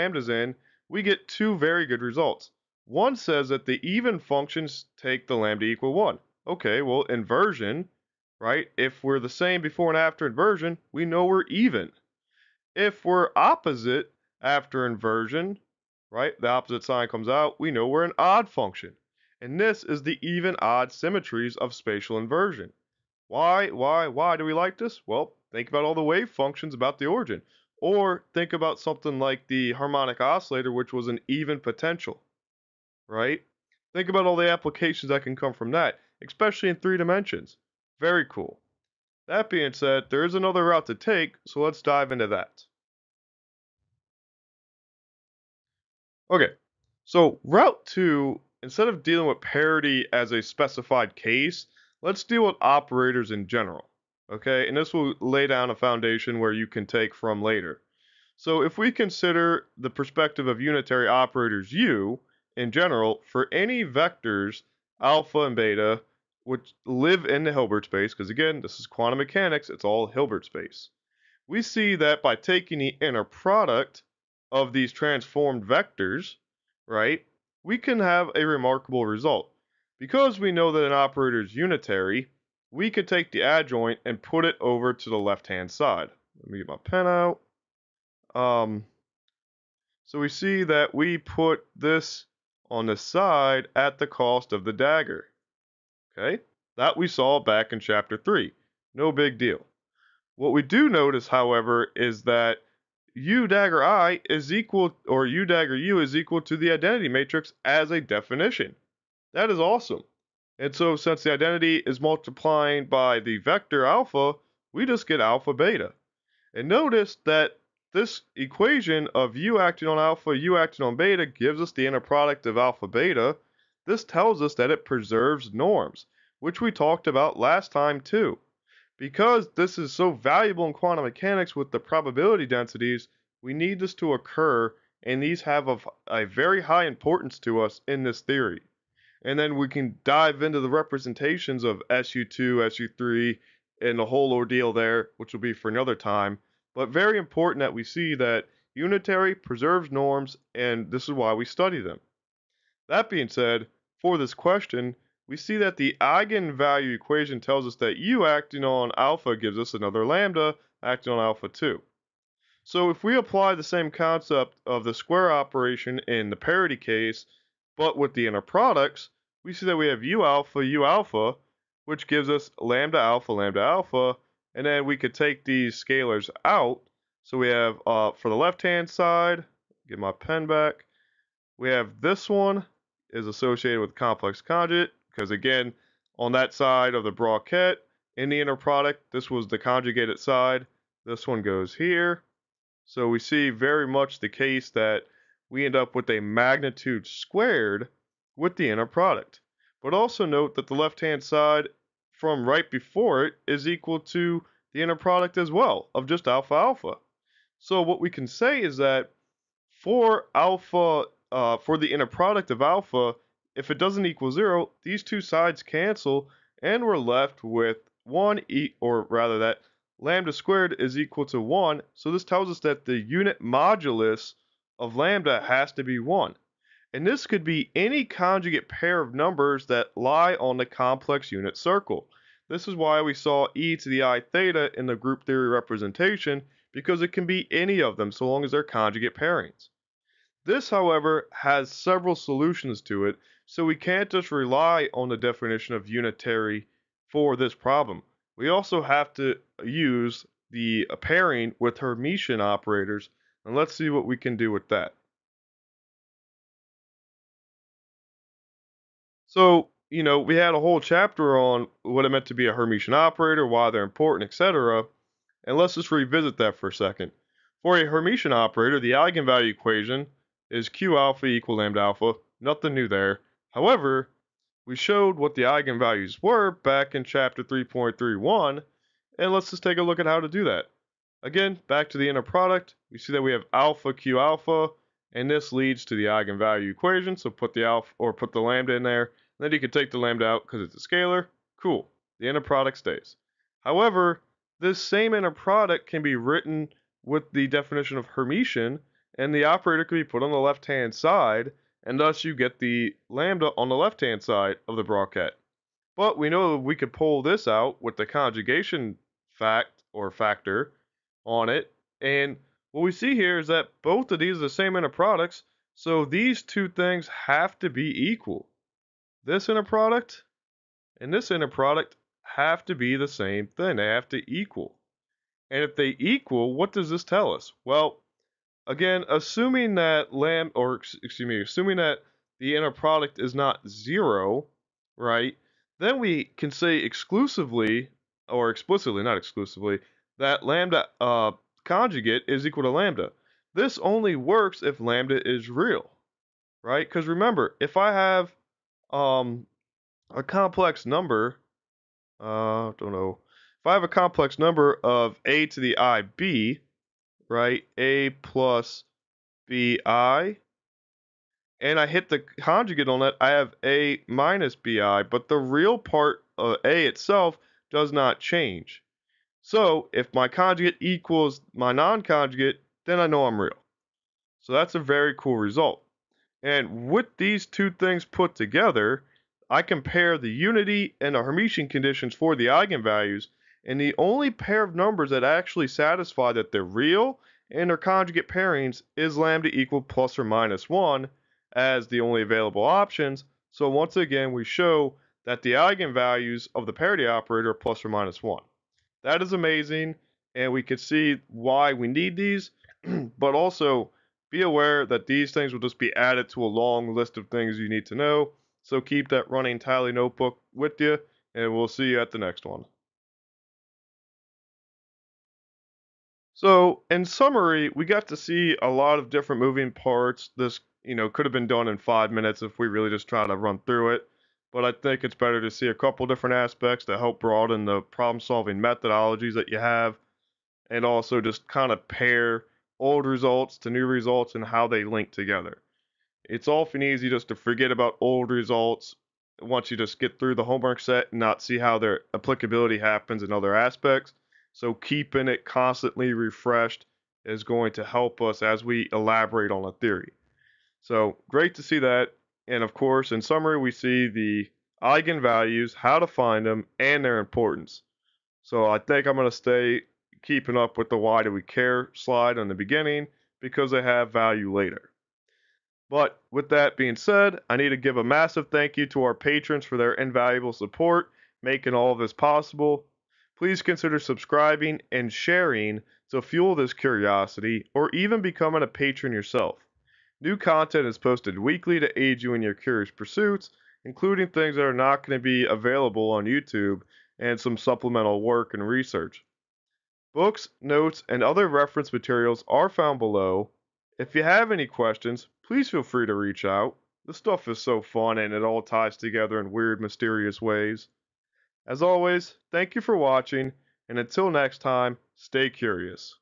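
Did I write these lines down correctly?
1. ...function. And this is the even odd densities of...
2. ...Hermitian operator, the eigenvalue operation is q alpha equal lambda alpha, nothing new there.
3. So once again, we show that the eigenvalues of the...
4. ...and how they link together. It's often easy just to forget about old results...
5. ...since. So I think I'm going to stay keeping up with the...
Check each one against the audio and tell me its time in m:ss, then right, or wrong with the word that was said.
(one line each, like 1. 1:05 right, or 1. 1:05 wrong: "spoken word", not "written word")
1. 0:18 wrong: "symmetries", not "densities"
2. 4:27 wrong: "equation", not "operation"
3. 6:33 right
4. 7:14 right
5. 7:37 wrong: "importance", not "since".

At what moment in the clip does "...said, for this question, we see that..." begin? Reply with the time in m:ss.
2:33.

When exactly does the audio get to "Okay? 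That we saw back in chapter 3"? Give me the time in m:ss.
1:36.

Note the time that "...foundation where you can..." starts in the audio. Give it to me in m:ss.
0:55.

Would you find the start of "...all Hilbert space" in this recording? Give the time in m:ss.
1:09.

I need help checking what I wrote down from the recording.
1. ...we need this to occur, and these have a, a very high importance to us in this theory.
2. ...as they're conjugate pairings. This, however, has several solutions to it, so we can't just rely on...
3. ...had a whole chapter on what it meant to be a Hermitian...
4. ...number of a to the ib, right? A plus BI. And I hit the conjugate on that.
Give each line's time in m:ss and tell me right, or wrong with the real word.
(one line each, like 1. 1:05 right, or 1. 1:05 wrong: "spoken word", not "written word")
1. 2:13 right
2. 3:58 right
3. 4:20 right
4. 5:54 right.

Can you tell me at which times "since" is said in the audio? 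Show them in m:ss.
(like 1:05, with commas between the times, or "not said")
1:50.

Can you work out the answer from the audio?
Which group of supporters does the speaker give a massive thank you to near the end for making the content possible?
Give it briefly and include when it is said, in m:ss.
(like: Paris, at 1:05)
Patrons, at 7:49.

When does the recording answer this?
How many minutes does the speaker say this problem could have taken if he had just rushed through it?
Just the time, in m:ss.
7:01.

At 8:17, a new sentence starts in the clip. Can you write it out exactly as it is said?
This stuff is so fun and it all ties together in weird, mysterious ways.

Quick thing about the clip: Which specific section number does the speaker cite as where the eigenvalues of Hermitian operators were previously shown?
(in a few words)
3.31.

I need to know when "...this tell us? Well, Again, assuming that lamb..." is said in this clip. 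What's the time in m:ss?
5:26.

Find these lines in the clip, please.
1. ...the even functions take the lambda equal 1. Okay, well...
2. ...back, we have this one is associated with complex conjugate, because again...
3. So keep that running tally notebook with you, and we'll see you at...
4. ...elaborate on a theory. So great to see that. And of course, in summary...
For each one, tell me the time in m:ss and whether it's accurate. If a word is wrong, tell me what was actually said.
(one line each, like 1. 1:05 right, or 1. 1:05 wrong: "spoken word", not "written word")
1. 0:03 right
2. 3:00 right
3. 6:48 right
4. 7:28 right.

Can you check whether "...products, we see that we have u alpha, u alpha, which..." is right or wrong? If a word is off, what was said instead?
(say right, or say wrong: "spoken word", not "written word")
right.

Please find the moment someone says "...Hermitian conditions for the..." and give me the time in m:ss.
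6:21.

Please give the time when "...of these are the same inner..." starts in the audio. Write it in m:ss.
5:14.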